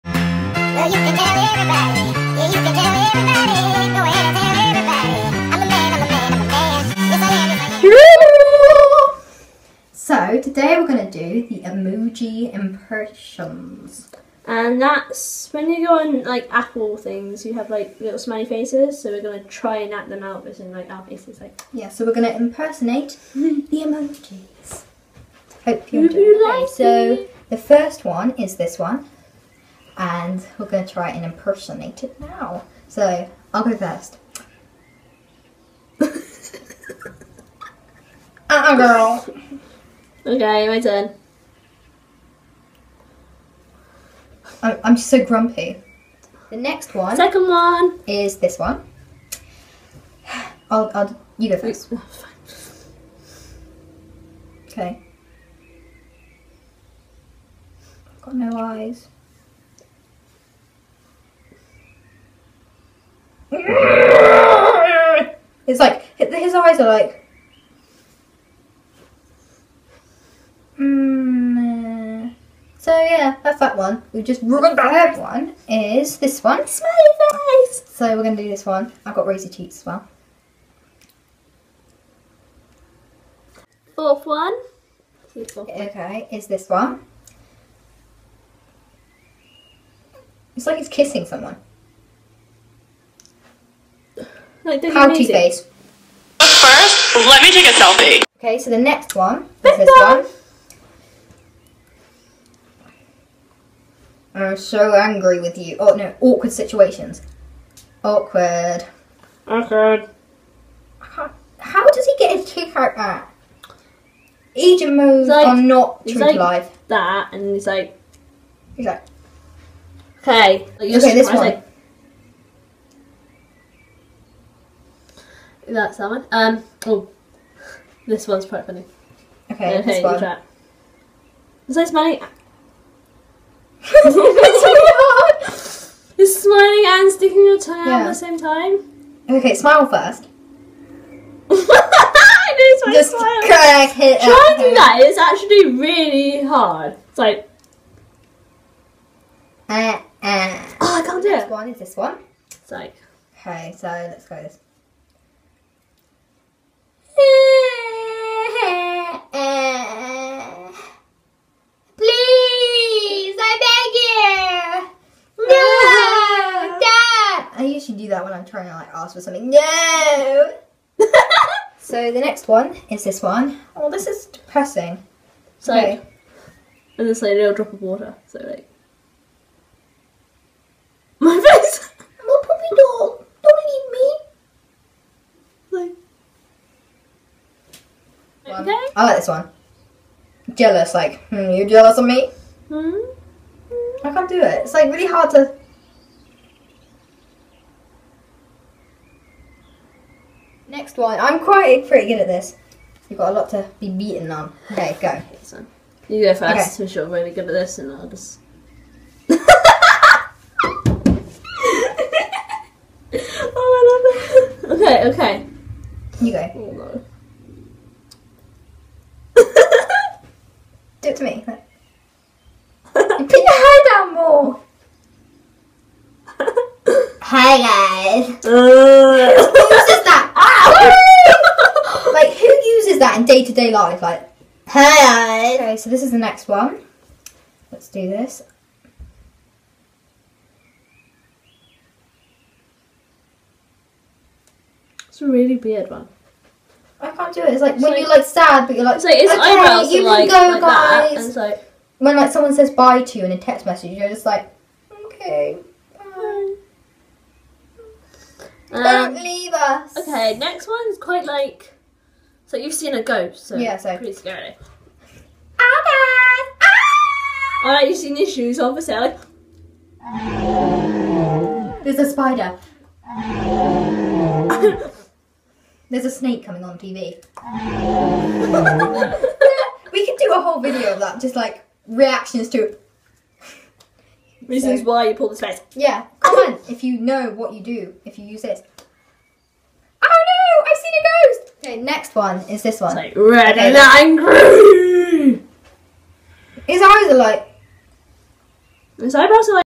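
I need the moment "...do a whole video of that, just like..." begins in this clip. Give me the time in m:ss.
4:40.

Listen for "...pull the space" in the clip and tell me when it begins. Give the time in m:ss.
4:45.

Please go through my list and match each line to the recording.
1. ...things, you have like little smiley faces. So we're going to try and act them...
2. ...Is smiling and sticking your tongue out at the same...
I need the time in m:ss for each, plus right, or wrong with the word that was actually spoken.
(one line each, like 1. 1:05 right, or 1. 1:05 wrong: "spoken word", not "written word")
1. 0:16 right
2. 2:16 right.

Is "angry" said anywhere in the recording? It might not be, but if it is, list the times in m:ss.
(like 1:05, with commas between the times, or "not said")
1:44, 4:53.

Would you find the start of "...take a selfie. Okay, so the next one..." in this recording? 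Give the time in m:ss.
1:37.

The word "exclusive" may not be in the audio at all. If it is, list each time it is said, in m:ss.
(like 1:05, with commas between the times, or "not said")
not said.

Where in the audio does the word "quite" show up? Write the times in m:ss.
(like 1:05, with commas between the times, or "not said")
2:08, 3:21, 4:20.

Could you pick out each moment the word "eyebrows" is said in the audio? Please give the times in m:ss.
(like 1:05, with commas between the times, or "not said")
4:59.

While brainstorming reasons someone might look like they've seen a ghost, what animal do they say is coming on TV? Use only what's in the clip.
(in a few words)
A snake.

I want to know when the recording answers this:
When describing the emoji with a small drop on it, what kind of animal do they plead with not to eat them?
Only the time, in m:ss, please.
3:01.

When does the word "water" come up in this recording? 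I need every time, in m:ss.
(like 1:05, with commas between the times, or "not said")
2:57.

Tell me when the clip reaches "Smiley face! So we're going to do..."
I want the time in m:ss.
1:16.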